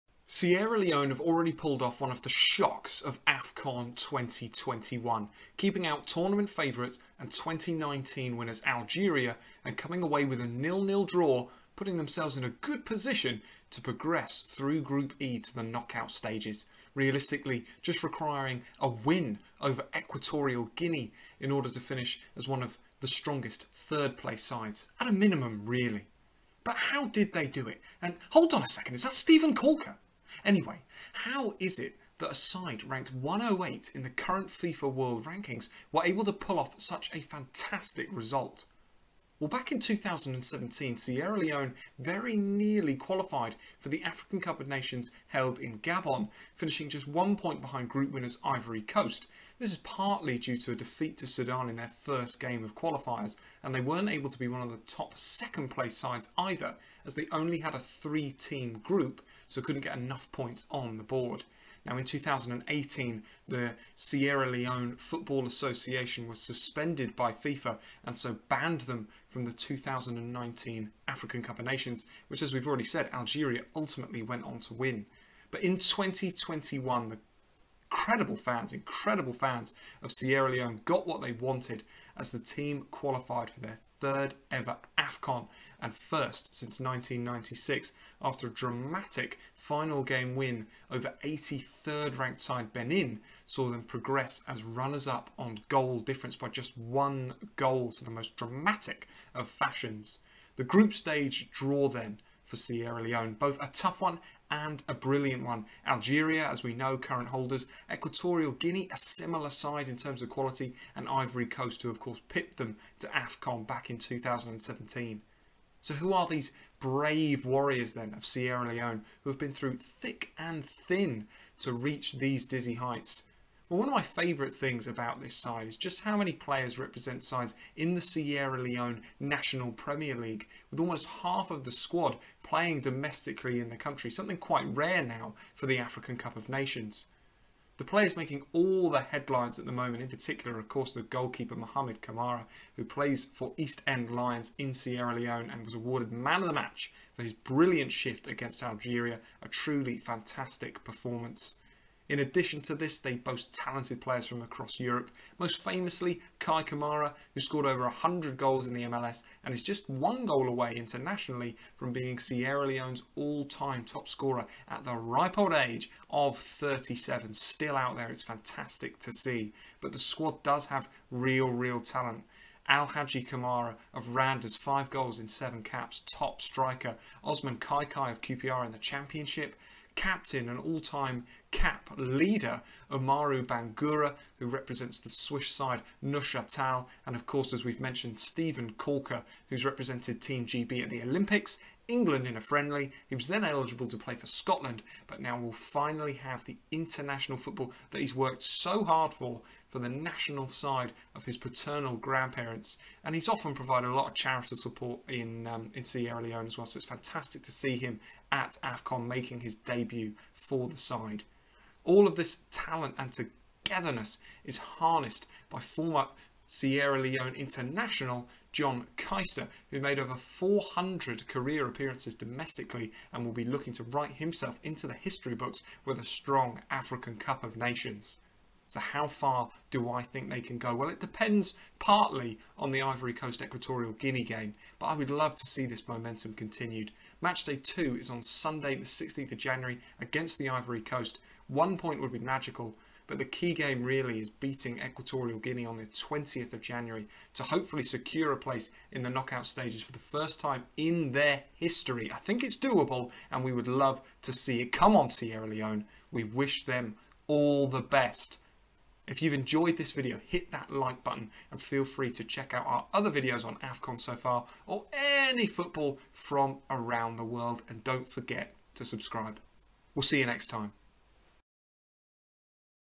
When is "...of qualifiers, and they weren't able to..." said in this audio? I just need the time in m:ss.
0:52.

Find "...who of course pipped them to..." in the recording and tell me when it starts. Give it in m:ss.
1:51.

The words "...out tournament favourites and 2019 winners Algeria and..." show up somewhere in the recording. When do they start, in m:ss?
0:05.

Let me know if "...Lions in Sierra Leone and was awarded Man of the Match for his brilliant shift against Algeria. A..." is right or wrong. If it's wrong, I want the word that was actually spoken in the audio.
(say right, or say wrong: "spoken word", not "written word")
right.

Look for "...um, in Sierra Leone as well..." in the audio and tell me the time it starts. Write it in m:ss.
3:25.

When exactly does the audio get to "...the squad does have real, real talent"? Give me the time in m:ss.
2:49.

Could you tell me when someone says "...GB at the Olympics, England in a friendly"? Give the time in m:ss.
3:10.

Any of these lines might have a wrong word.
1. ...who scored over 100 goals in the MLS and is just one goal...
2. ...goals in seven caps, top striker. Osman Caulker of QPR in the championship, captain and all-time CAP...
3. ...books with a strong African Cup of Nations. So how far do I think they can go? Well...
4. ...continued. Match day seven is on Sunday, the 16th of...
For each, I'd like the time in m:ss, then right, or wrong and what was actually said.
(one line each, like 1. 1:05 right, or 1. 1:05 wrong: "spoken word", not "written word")
1. 2:37 right
2. 2:54 wrong: "Kakay", not "Caulker"
3. 3:45 right
4. 3:56 wrong: "two", not "seven".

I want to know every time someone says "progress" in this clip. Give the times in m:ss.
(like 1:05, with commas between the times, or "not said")
0:13, 1:33.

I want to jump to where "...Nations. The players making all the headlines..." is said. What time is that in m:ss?
2:16.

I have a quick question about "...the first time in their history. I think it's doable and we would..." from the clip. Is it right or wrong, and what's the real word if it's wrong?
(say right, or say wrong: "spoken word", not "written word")
right.